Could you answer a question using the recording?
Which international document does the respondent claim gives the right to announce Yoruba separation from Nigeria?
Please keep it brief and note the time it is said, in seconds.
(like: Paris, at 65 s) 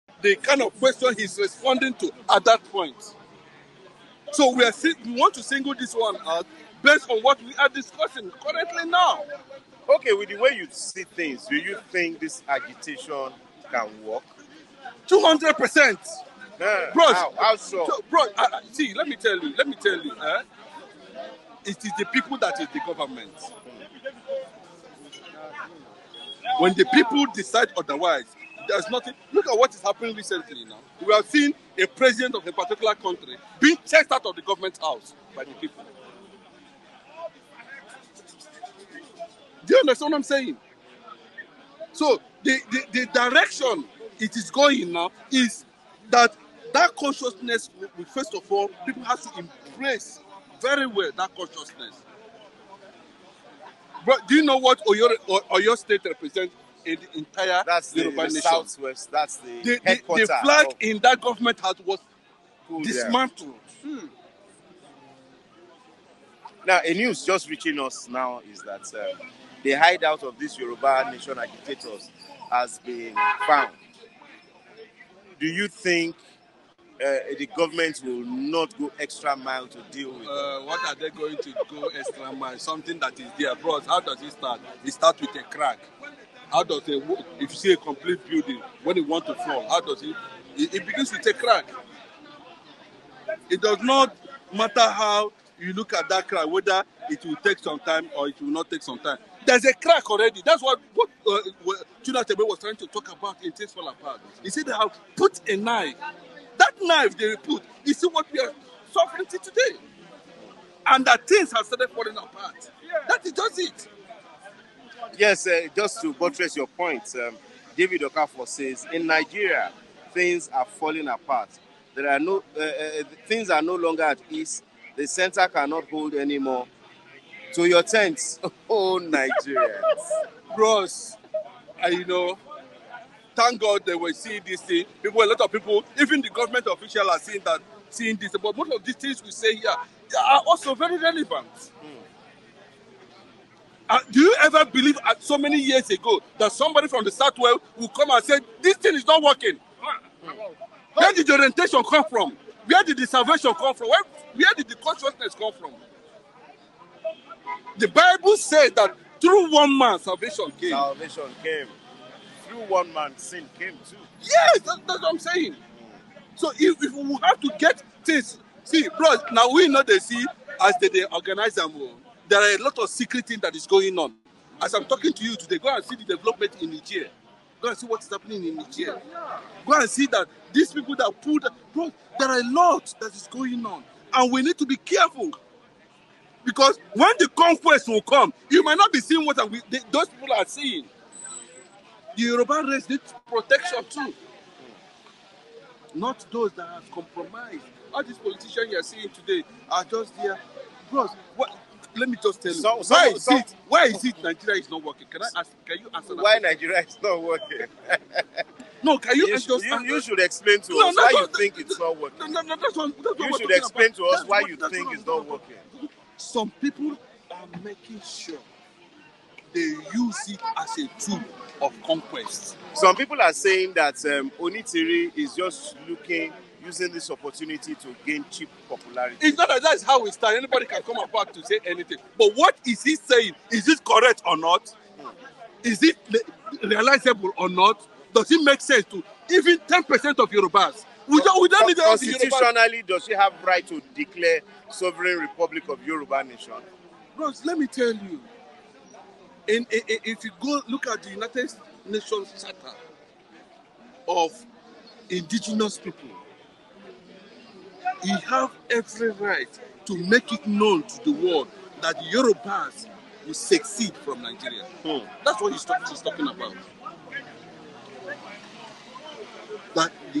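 United Nations Charter of indigenous people, at 251 s.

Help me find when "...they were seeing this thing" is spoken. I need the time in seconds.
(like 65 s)
133 s.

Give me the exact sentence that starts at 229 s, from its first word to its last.
It's not that that's how we start.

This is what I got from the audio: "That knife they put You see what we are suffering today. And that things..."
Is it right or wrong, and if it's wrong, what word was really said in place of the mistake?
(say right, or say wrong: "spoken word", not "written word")
right.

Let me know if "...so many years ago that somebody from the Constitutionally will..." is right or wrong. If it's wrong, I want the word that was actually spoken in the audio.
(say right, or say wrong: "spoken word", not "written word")
wrong: "Southwest", not "Constitutionally".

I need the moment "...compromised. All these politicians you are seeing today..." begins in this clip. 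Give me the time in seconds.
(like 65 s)
196 s.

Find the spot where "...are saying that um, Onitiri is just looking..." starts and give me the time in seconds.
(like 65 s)
223 s.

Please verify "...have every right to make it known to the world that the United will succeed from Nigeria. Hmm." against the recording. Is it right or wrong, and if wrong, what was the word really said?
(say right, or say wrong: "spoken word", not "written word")
wrong: "Yorubas", not "United".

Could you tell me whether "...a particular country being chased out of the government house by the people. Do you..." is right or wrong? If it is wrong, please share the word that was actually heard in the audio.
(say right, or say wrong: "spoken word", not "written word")
right.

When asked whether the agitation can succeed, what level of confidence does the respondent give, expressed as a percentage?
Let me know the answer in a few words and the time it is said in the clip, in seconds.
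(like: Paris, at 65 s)
200 percent, at 15 s.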